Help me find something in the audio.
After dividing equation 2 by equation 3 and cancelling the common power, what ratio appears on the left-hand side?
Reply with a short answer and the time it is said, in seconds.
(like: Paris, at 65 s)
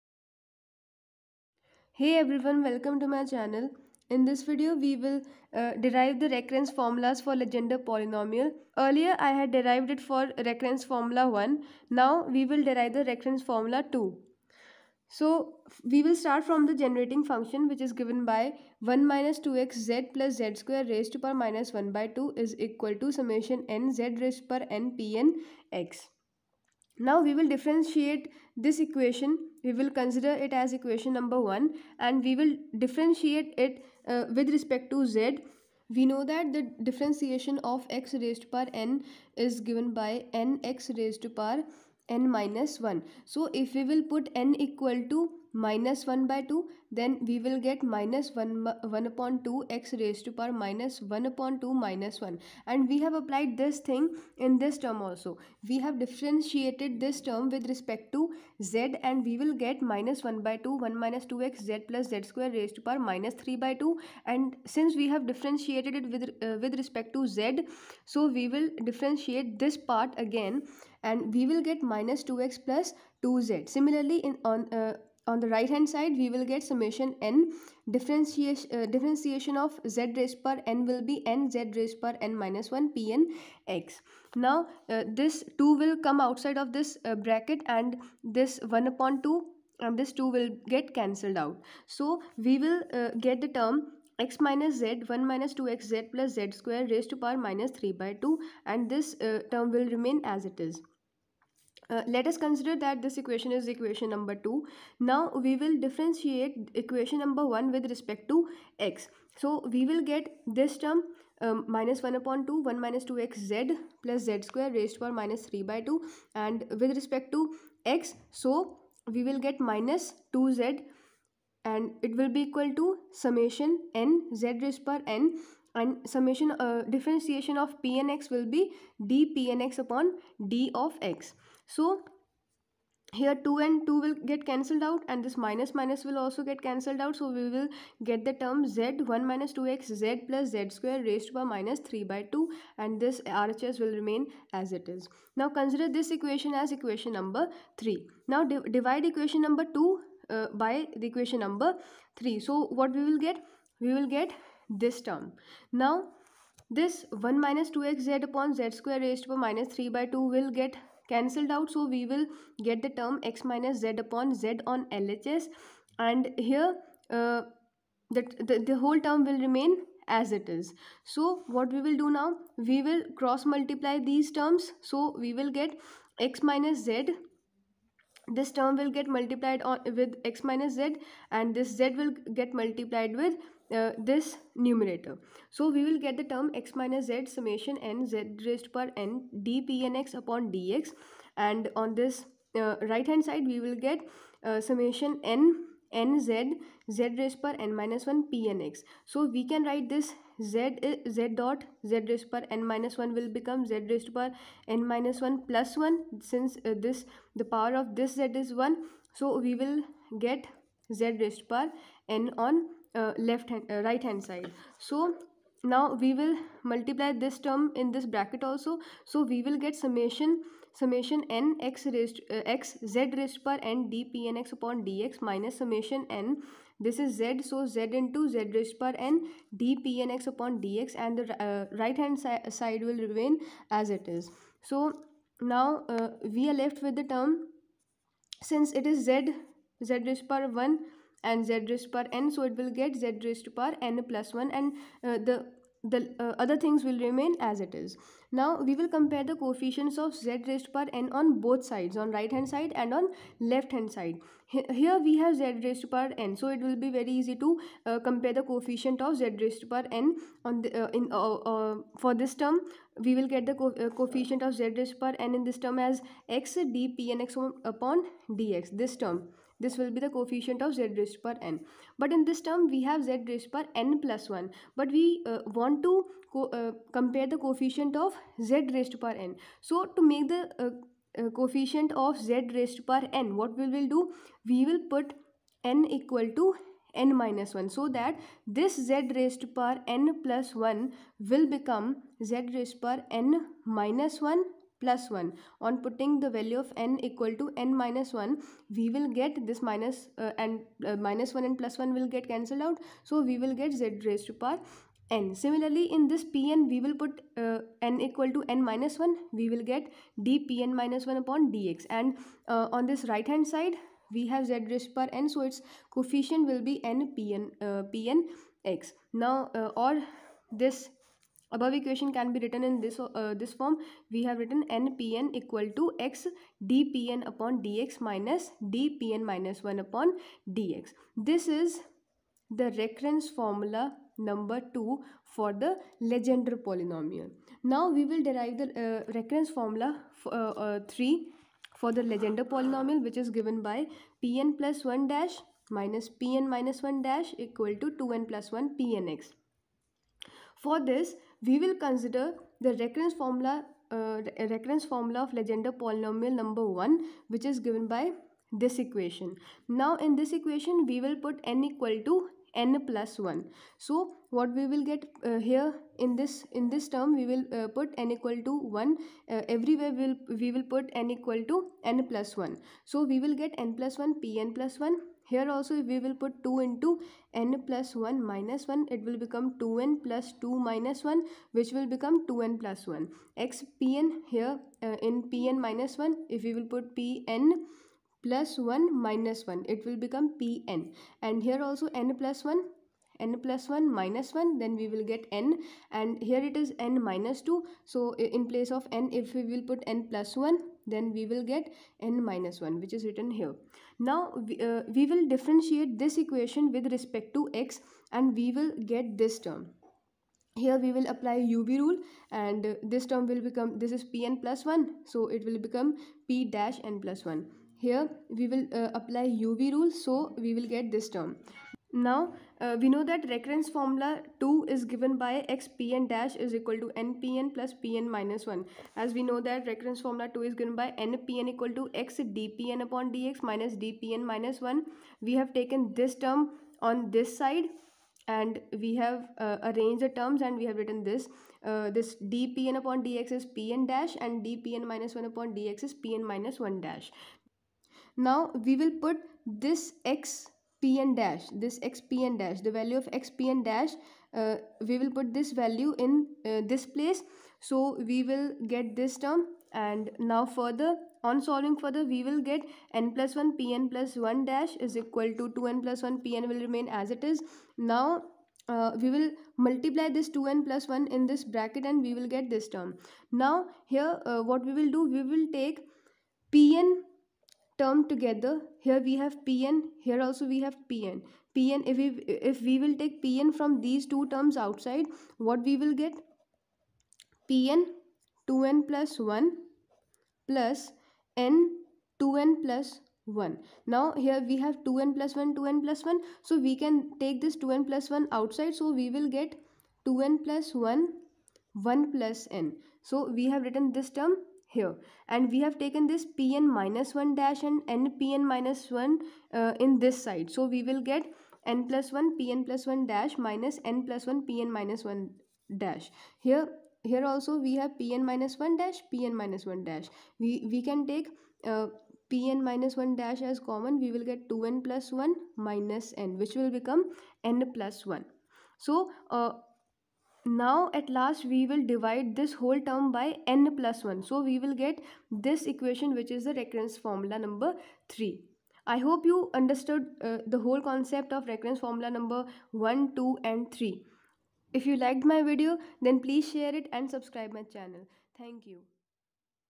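x minus z upon z, at 163 s.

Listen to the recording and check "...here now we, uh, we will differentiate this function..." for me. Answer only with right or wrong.
wrong.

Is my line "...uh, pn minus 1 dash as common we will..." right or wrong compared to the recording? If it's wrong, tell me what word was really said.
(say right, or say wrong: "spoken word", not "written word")
right.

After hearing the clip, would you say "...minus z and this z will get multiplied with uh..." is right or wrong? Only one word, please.
right.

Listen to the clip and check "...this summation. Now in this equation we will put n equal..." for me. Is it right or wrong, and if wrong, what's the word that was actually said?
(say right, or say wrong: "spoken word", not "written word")
wrong: "equation", not "summation".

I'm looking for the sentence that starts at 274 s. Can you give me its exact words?
But we uh, want to uh, compare the coefficient of z raised per n.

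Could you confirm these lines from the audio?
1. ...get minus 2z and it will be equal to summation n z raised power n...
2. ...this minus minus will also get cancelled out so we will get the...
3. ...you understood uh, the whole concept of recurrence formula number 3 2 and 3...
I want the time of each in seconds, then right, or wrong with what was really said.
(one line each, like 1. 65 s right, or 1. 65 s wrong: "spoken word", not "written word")
1. 119 s right
2. 135 s right
3. 539 s wrong: "1", not "3".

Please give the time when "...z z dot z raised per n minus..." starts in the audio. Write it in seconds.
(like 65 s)
200 s.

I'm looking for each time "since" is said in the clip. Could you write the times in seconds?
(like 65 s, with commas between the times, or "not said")
64 s, 206 s, 238 s.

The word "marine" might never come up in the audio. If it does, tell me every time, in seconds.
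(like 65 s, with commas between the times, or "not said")
not said.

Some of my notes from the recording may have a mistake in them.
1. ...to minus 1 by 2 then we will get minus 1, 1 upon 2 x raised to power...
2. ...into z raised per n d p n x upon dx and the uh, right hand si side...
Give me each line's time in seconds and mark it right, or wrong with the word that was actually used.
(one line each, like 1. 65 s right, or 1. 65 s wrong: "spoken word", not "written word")
1. 45 s right
2. 228 s right.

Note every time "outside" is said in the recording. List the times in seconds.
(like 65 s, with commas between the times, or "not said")
86 s, 484 s, 498 s.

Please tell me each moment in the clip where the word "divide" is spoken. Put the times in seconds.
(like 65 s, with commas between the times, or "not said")
148 s, 531 s.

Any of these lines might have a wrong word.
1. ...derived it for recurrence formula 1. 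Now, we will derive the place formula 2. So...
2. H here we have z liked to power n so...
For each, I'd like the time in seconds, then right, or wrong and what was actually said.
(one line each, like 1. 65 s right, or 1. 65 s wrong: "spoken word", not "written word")
1. 9 s wrong: "recurrence", not "place"
2. 254 s wrong: "raised", not "liked".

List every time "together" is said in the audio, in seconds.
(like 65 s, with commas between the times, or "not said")
478 s.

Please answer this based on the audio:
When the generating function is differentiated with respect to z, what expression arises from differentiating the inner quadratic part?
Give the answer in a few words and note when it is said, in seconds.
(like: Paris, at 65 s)
minus 2x plus 2z, at 71 s.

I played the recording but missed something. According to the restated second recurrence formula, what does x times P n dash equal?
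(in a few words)
nPn plus Pn minus 1 dash.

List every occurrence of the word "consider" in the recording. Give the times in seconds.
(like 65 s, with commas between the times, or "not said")
29 s, 102 s, 145 s, 351 s.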